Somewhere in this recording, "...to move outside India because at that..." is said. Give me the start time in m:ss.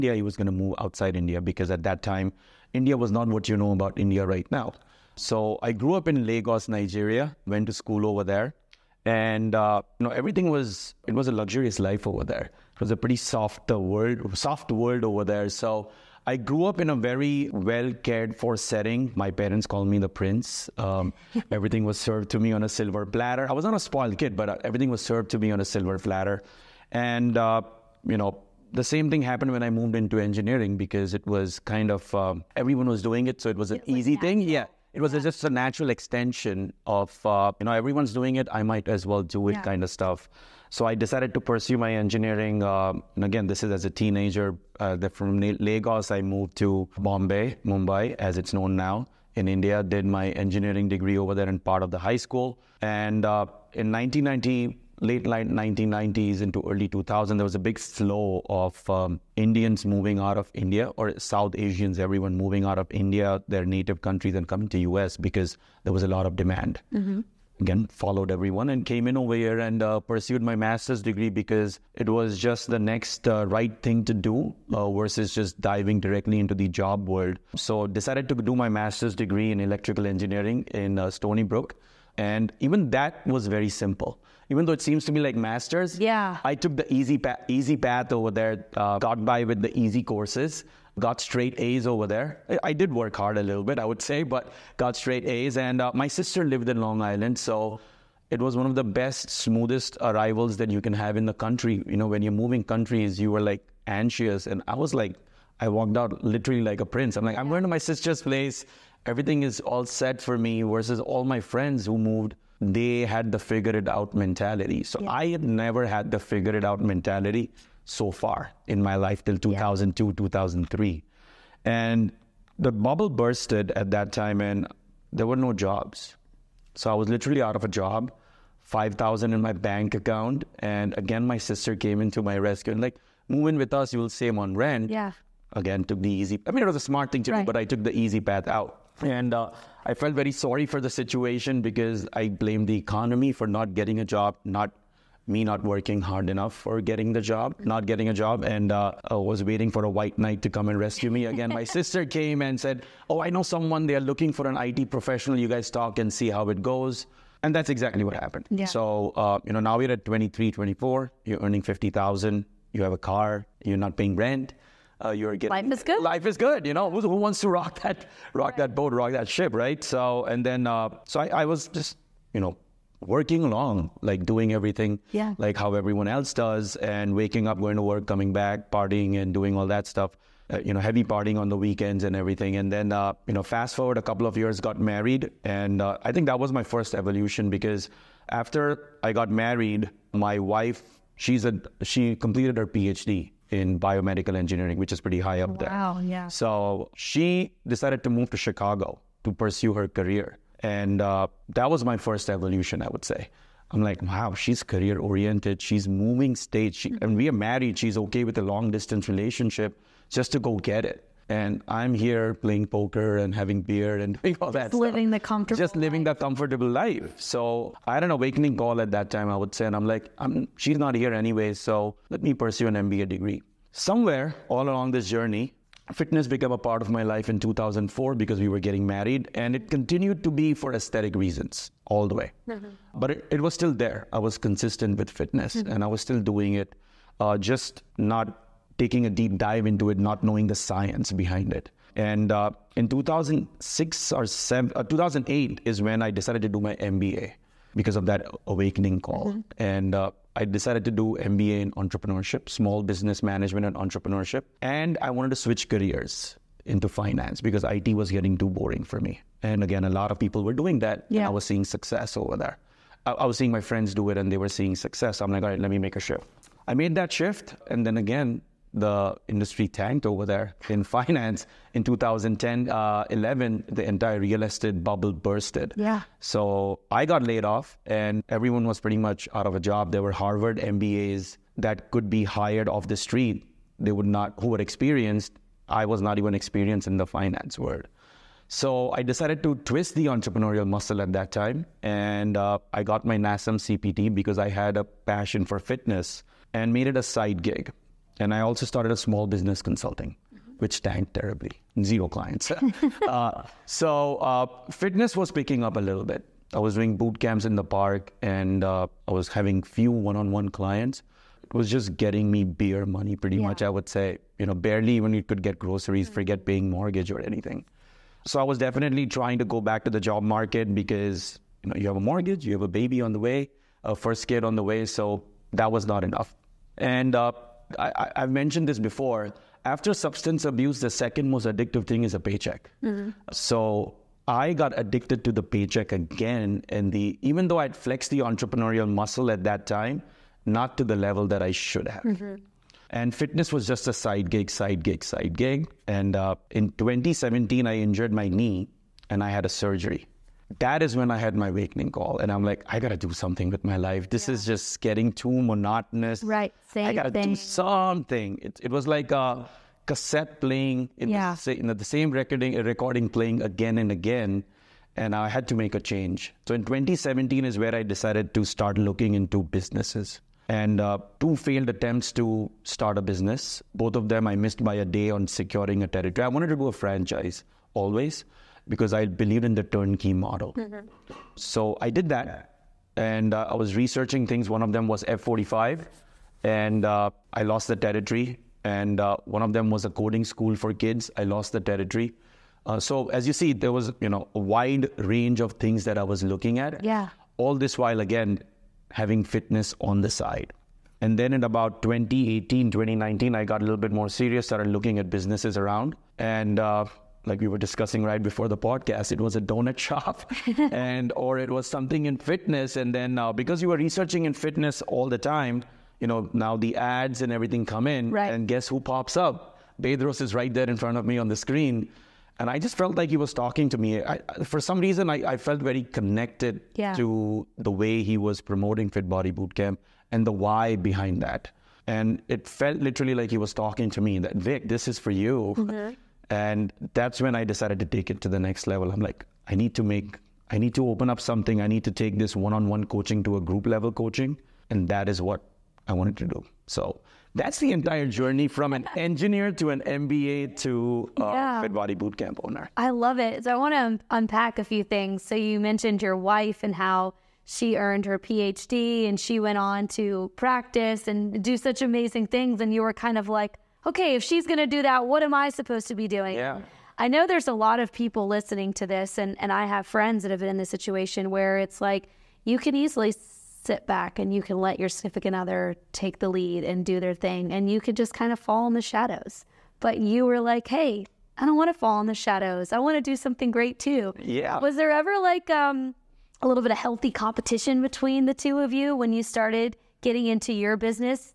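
0:00.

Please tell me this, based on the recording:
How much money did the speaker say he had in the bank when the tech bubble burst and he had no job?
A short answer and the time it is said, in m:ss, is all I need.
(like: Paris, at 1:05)
$5,000, at 2:08.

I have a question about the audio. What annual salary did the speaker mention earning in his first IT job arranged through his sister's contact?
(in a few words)
$50,000.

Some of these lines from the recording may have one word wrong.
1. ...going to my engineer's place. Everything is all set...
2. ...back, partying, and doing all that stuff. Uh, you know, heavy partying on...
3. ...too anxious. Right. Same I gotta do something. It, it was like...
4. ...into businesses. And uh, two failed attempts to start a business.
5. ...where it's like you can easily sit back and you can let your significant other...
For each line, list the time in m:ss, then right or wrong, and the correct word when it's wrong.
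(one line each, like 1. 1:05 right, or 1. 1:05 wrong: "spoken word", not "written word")
1. 1:47 wrong: "sister", not "engineer"
2. 2:58 right
3. 5:55 wrong: "monotonous", not "anxious"
4. 6:09 right
5. 7:51 right.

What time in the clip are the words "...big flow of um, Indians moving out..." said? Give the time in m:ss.
0:57.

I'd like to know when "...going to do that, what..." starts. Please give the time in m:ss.
7:44.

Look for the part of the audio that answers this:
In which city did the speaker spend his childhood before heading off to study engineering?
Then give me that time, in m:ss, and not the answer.
0:06.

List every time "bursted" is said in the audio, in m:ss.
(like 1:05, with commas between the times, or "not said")
2:03, 4:35.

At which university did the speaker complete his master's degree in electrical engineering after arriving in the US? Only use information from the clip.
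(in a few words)
Stony Brook.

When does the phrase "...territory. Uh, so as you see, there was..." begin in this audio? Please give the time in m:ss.
6:31.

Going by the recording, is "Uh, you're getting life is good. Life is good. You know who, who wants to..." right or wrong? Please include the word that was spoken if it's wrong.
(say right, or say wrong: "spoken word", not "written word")
right.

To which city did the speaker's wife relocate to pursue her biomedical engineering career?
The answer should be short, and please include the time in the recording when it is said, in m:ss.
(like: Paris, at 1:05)
Chicago, at 3:18.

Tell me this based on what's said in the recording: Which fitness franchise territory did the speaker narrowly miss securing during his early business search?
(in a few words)
F45.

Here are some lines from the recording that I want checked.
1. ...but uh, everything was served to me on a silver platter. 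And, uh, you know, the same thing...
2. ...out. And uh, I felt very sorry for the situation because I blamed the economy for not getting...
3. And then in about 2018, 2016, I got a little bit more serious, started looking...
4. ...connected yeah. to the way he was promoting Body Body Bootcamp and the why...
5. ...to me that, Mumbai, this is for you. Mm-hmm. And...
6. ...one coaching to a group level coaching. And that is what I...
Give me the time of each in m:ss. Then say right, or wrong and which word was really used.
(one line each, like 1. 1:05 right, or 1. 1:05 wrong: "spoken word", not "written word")
1. 0:24 right
2. 2:18 right
3. 6:41 wrong: "2019", not "2016"
4. 7:05 wrong: "Fit", not "Body"
5. 7:13 wrong: "Vik", not "Mumbai"
6. 7:22 right.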